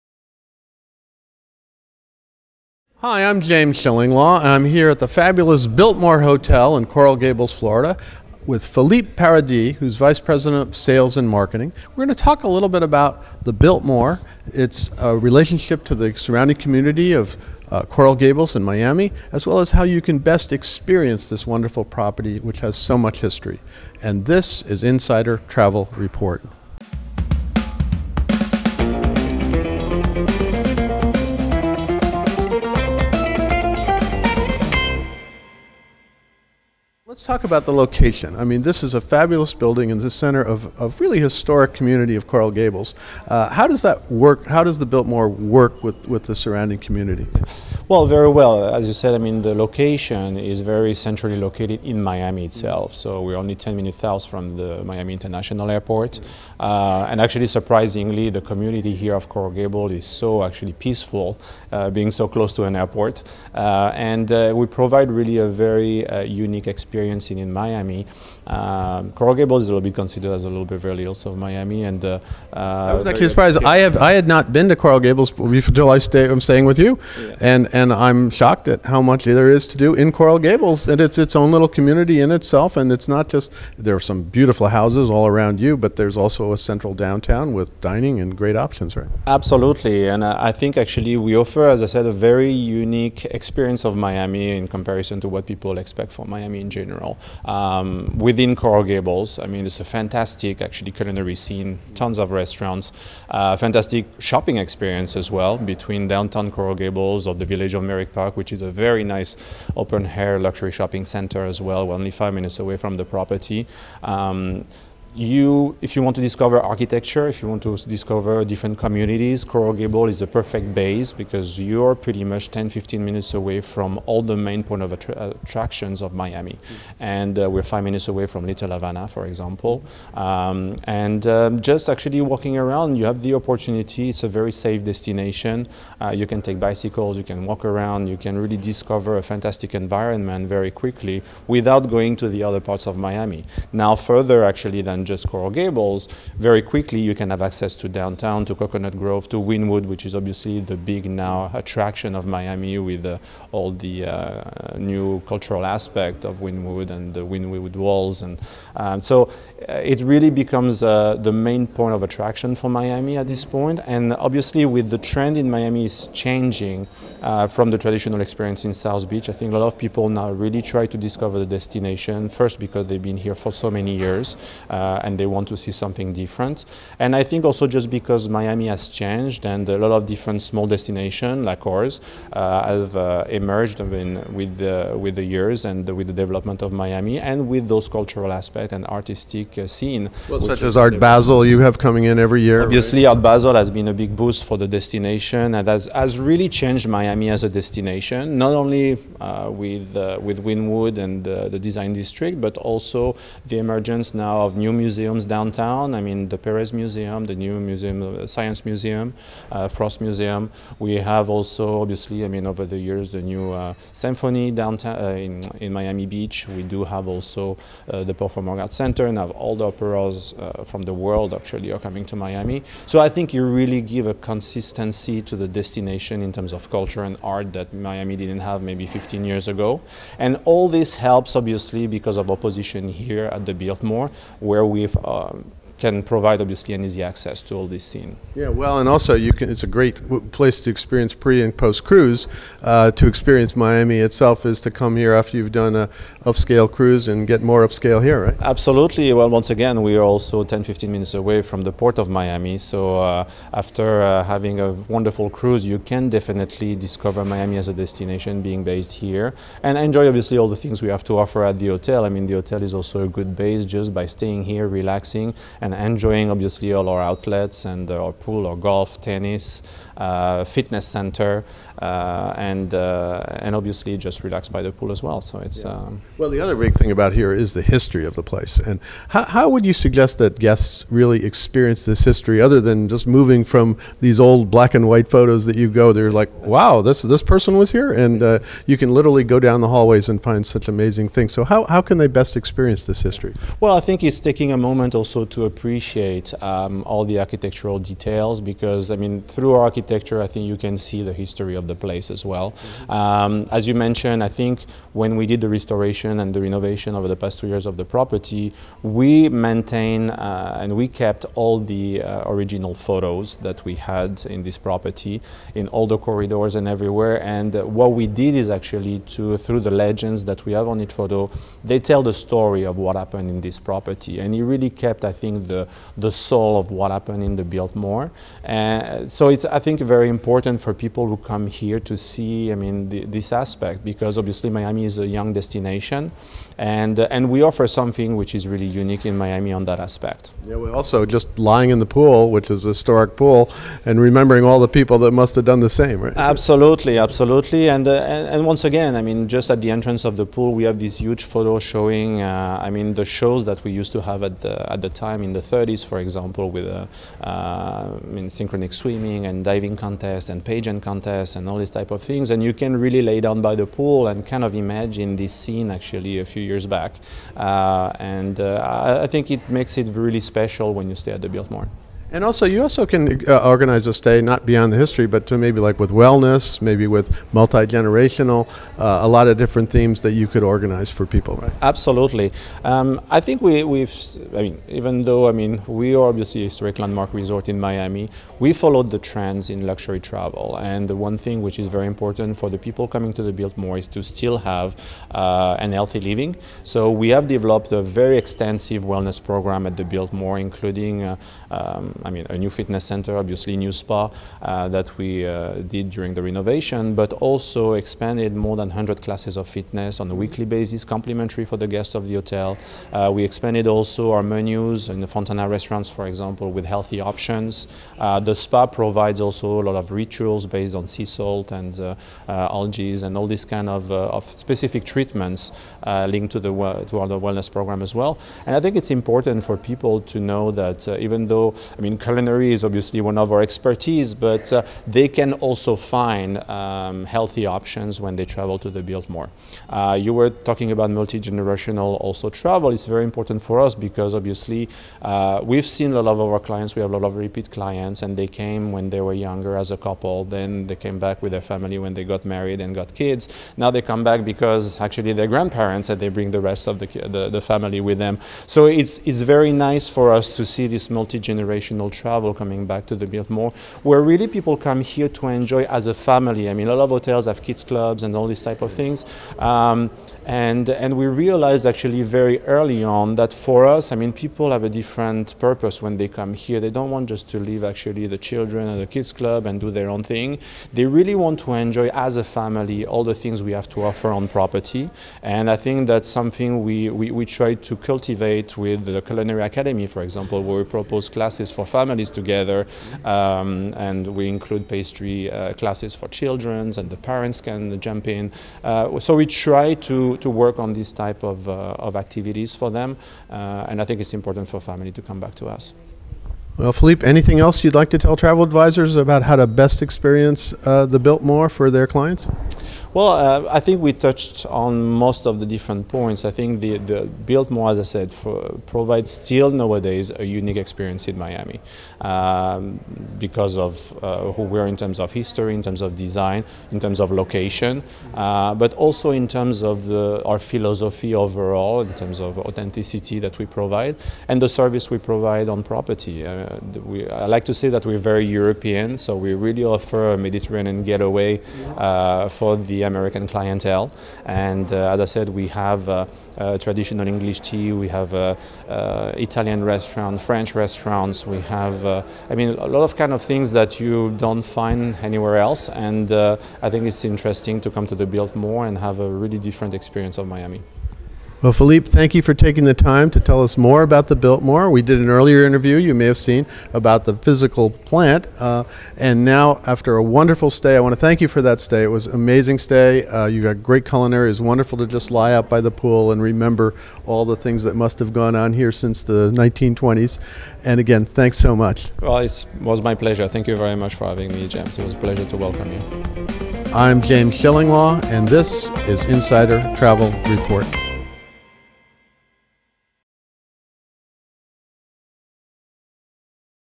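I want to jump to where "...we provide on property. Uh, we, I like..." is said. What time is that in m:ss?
8:54.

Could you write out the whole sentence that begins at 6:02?
And you can really lay down by the pool and kind of imagine this scene actually a few years back.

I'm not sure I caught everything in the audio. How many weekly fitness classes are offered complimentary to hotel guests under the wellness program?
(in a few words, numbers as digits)
more than 100.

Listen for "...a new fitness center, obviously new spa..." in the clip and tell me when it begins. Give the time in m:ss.
6:42.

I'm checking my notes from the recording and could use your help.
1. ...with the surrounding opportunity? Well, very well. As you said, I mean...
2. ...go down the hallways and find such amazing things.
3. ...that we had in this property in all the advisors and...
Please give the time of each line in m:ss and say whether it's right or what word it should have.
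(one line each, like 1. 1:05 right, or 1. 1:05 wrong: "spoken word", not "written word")
1. 0:46 wrong: "community", not "opportunity"
2. 4:49 right
3. 5:13 wrong: "corridors", not "advisors".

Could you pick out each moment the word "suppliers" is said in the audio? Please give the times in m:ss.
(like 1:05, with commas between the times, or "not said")
not said.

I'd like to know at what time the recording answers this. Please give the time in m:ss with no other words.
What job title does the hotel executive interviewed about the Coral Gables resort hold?
0:09.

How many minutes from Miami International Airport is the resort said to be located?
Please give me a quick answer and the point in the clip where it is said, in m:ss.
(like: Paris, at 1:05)
10, at 0:53.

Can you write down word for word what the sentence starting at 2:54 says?
Uh, uh, and they want to see something different.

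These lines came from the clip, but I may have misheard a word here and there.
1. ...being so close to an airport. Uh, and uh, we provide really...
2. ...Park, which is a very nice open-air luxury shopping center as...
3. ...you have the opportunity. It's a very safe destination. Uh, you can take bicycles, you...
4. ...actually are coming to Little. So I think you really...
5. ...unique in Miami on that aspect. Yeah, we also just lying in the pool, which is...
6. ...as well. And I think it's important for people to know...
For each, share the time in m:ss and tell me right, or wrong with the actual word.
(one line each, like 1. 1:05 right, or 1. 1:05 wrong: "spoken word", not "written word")
1. 1:01 right
2. 1:48 right
3. 2:12 right
4. 3:41 wrong: "Miami", not "Little"
5. 5:38 right
6. 7:07 right.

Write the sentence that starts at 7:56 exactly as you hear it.
They don't want just to leave actually the children and the kids club and do their own thing.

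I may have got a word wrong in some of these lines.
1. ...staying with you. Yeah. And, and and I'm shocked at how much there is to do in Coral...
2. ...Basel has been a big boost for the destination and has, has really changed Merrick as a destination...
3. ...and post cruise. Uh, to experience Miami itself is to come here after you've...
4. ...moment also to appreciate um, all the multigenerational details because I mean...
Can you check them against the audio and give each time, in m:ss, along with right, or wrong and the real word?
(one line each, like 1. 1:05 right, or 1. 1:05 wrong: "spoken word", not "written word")
1. 1:16 right
2. 3:13 wrong: "Miami", not "Merrick"
3. 4:01 right
4. 4:54 wrong: "architectural", not "multigenerational".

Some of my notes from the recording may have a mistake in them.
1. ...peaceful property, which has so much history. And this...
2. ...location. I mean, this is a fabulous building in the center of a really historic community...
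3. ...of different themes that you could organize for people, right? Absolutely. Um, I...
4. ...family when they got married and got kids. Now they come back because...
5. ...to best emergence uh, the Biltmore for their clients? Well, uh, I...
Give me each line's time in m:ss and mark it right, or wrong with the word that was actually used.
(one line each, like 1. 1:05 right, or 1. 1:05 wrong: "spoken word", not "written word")
1. 0:21 wrong: "wonderful", not "peaceful"
2. 0:37 right
3. 6:19 right
4. 7:31 right
5. 8:29 wrong: "experience", not "emergence".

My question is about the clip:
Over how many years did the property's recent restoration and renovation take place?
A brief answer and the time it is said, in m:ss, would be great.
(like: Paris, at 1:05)
2, at 5:07.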